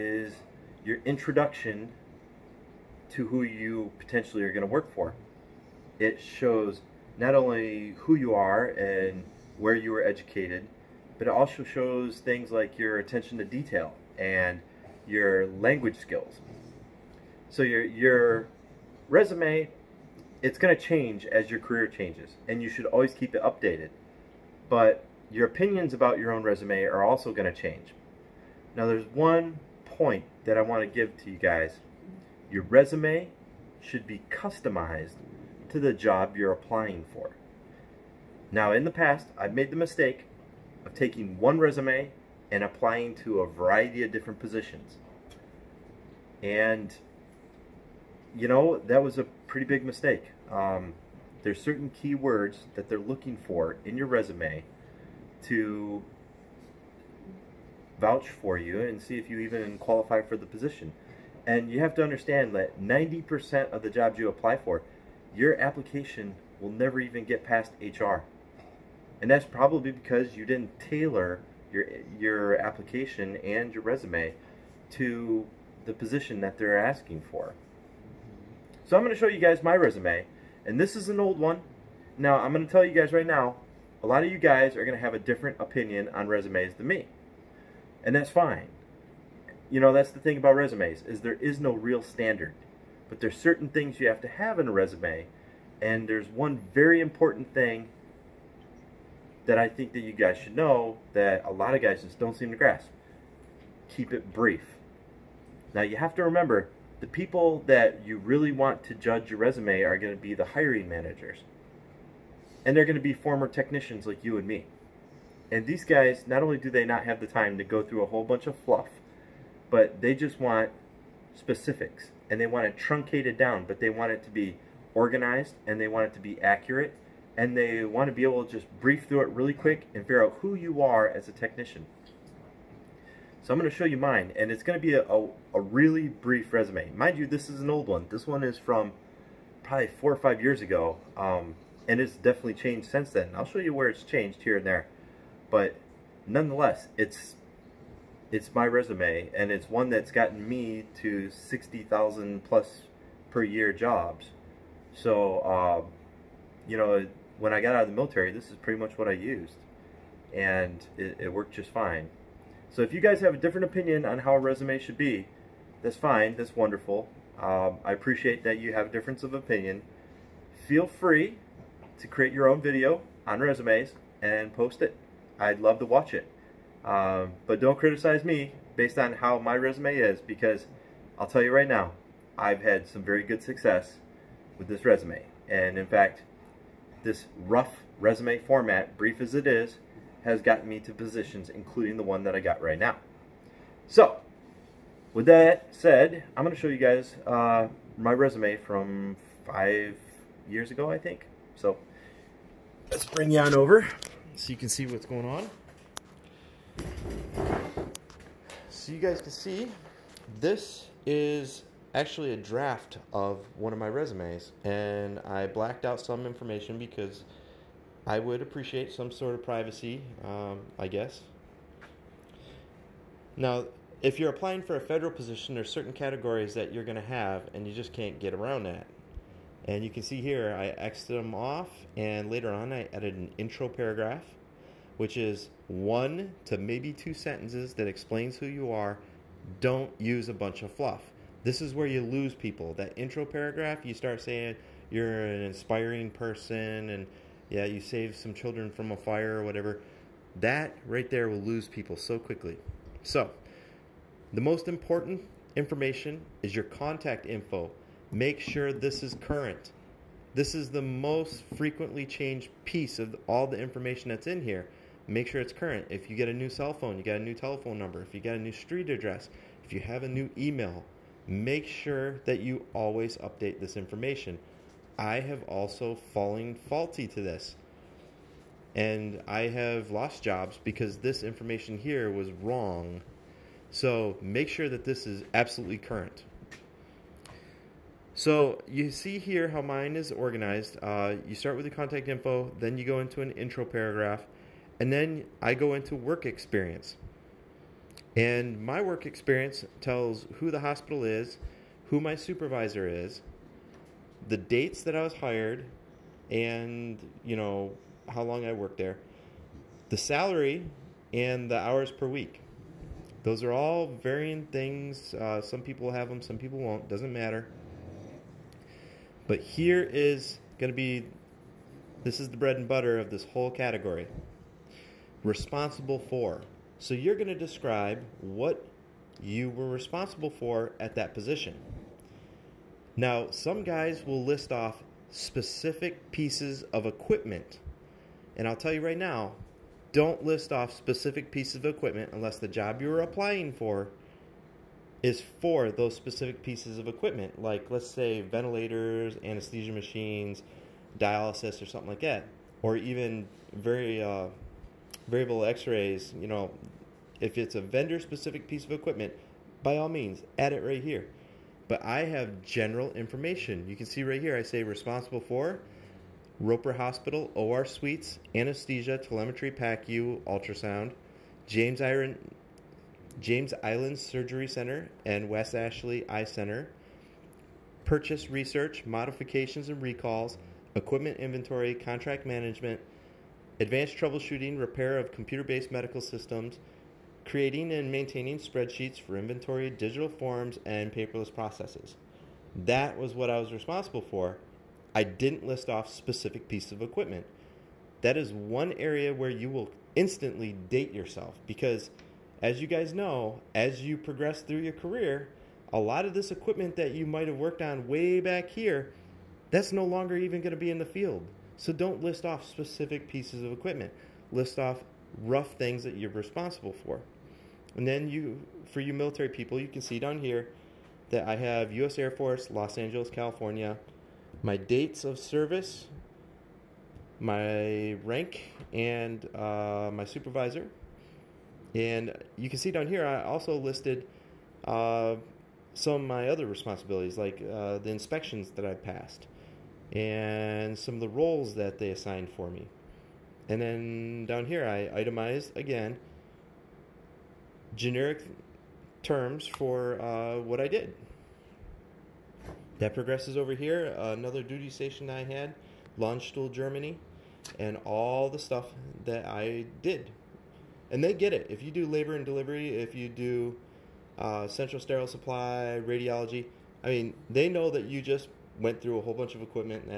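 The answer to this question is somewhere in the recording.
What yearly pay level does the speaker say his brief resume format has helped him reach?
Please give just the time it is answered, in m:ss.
2:31.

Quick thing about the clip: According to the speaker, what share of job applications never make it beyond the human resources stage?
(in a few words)
90%.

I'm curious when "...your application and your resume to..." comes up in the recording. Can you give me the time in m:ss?
1:12.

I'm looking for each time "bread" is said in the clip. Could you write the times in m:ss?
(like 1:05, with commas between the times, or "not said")
5:22.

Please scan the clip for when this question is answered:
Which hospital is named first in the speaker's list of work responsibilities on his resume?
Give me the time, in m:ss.
6:06.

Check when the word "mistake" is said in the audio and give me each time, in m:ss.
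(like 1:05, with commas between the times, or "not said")
0:39, 0:49.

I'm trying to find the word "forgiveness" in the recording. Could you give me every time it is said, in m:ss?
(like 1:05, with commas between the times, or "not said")
not said.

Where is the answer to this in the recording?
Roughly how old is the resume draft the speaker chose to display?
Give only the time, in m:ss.
2:19.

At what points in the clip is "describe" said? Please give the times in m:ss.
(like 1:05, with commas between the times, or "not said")
5:27.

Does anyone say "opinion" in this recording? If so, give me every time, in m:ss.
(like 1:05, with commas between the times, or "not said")
0:25, 1:25, 2:43, 2:49.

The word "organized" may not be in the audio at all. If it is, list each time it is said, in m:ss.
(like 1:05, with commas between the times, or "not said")
2:04, 4:50.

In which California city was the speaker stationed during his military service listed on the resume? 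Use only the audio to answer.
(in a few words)
Los Angeles.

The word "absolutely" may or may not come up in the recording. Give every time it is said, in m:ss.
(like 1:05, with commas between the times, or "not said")
4:45.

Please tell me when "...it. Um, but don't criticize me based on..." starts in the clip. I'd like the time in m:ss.
2:56.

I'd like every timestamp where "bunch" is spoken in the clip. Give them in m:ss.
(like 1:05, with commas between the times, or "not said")
1:58, 4:00, 7:49.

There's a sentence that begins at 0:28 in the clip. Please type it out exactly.
Now there's one point that I want to give to you guys.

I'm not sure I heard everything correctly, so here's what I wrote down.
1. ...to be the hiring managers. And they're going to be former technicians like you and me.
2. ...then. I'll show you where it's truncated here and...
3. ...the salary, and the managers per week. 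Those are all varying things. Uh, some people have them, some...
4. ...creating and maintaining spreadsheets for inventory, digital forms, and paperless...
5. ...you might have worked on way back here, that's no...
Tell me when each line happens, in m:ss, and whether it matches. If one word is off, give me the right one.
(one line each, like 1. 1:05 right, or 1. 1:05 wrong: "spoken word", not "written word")
1. 1:50 right
2. 2:23 wrong: "changed", not "truncated"
3. 5:09 wrong: "hours", not "managers"
4. 6:27 right
5. 6:46 right.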